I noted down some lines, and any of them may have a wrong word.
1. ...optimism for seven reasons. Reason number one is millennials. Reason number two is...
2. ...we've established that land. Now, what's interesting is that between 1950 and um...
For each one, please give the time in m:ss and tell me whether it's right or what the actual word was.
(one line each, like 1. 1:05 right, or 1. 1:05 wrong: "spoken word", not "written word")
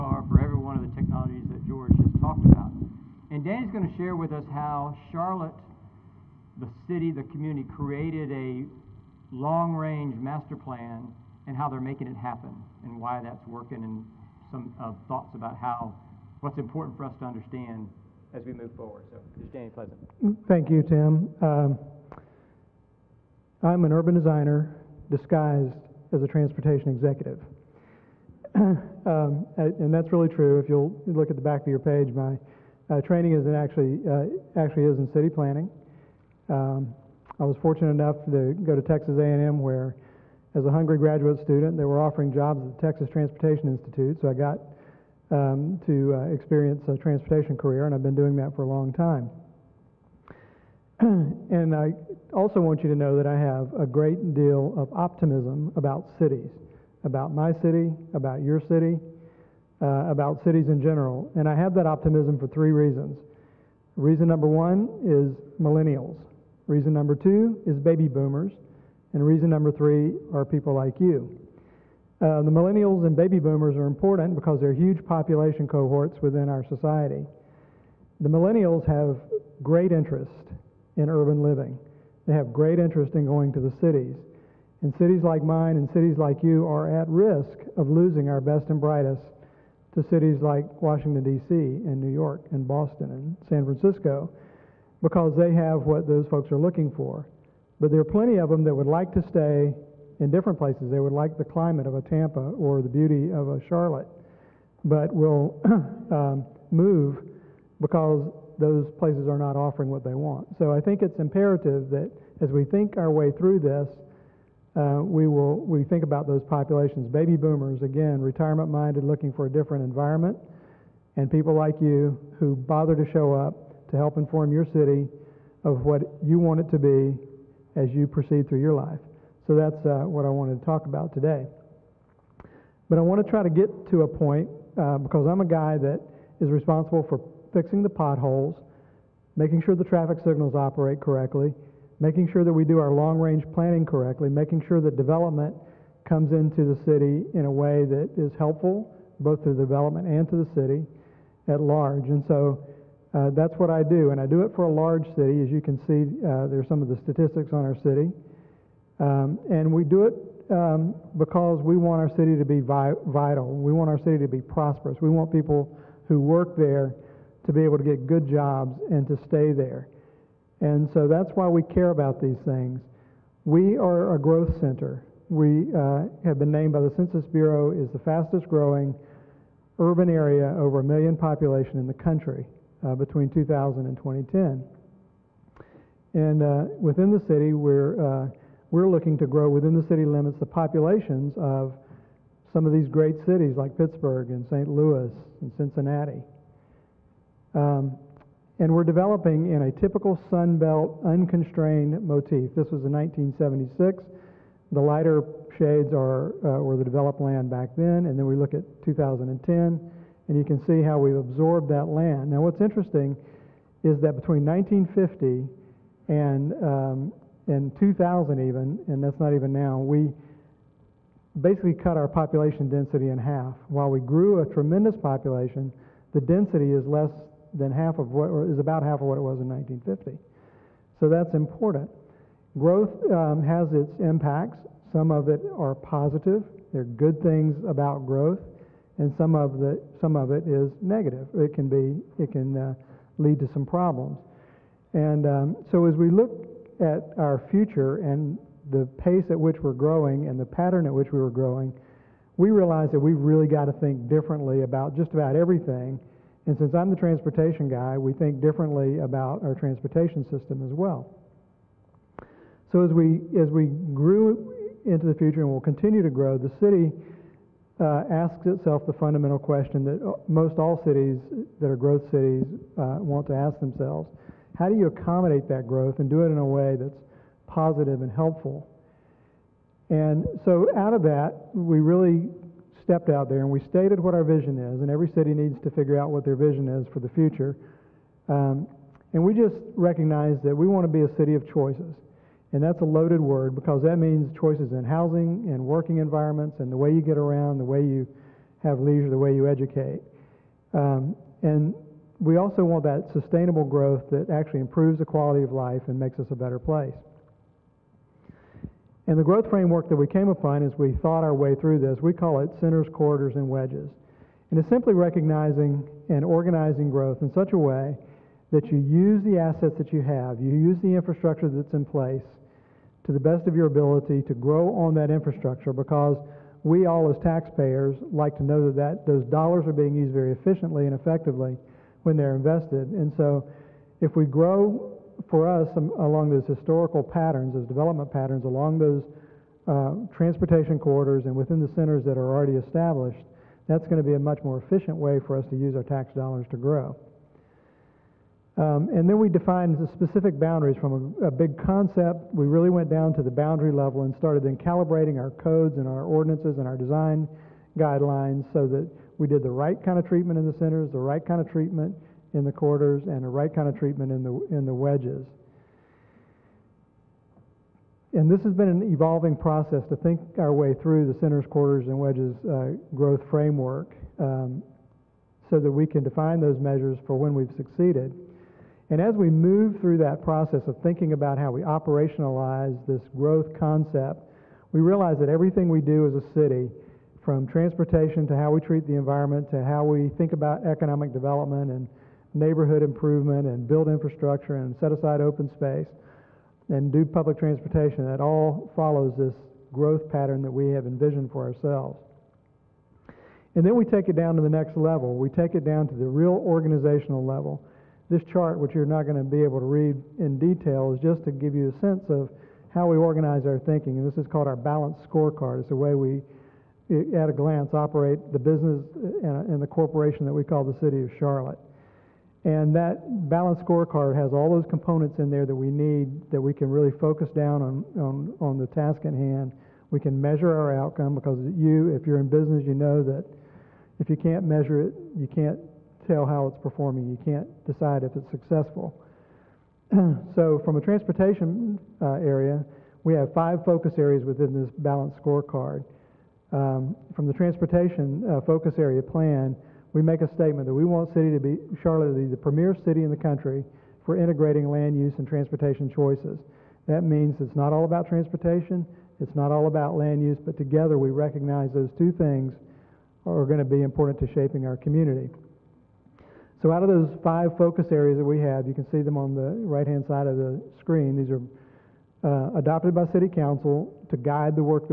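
1. 1:01 wrong: "three", not "seven"
2. 3:30 wrong: "absorbed", not "established".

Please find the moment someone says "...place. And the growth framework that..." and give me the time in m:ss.
5:06.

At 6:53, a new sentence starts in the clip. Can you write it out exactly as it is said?
And this is called our balanced scorecard.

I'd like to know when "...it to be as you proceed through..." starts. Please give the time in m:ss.
2:06.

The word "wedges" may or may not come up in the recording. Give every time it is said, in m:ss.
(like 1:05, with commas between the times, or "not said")
5:13, 6:04, 6:11.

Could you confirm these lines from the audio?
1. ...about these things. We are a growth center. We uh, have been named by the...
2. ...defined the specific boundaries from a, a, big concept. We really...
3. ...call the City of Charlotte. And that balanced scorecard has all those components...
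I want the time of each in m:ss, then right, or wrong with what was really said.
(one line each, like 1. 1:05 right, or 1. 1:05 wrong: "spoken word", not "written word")
1. 2:51 right
2. 5:49 right
3. 7:00 right.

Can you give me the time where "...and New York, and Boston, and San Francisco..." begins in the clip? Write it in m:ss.
1:31.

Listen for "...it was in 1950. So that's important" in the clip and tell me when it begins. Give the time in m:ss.
3:49.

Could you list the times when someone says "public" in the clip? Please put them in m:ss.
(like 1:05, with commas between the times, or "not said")
6:37.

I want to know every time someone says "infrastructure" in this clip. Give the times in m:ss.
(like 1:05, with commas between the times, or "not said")
5:20, 5:25, 6:33.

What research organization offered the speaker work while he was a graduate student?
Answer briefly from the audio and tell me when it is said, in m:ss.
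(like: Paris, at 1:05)
Texas Transportation Institute, at 0:42.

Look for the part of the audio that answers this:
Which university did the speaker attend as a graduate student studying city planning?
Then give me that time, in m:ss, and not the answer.
0:38.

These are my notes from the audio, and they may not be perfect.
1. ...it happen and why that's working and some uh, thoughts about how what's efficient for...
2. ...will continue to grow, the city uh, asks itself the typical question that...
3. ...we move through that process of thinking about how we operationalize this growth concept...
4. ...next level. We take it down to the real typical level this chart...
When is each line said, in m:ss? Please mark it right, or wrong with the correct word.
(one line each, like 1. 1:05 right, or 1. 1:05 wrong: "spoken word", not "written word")
1. 0:12 wrong: "important", not "efficient"
2. 4:25 wrong: "fundamental", not "typical"
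3. 6:19 right
4. 6:44 wrong: "organizational", not "typical".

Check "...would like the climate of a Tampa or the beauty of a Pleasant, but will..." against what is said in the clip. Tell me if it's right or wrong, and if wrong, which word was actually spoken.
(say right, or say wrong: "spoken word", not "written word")
wrong: "Charlotte", not "Pleasant".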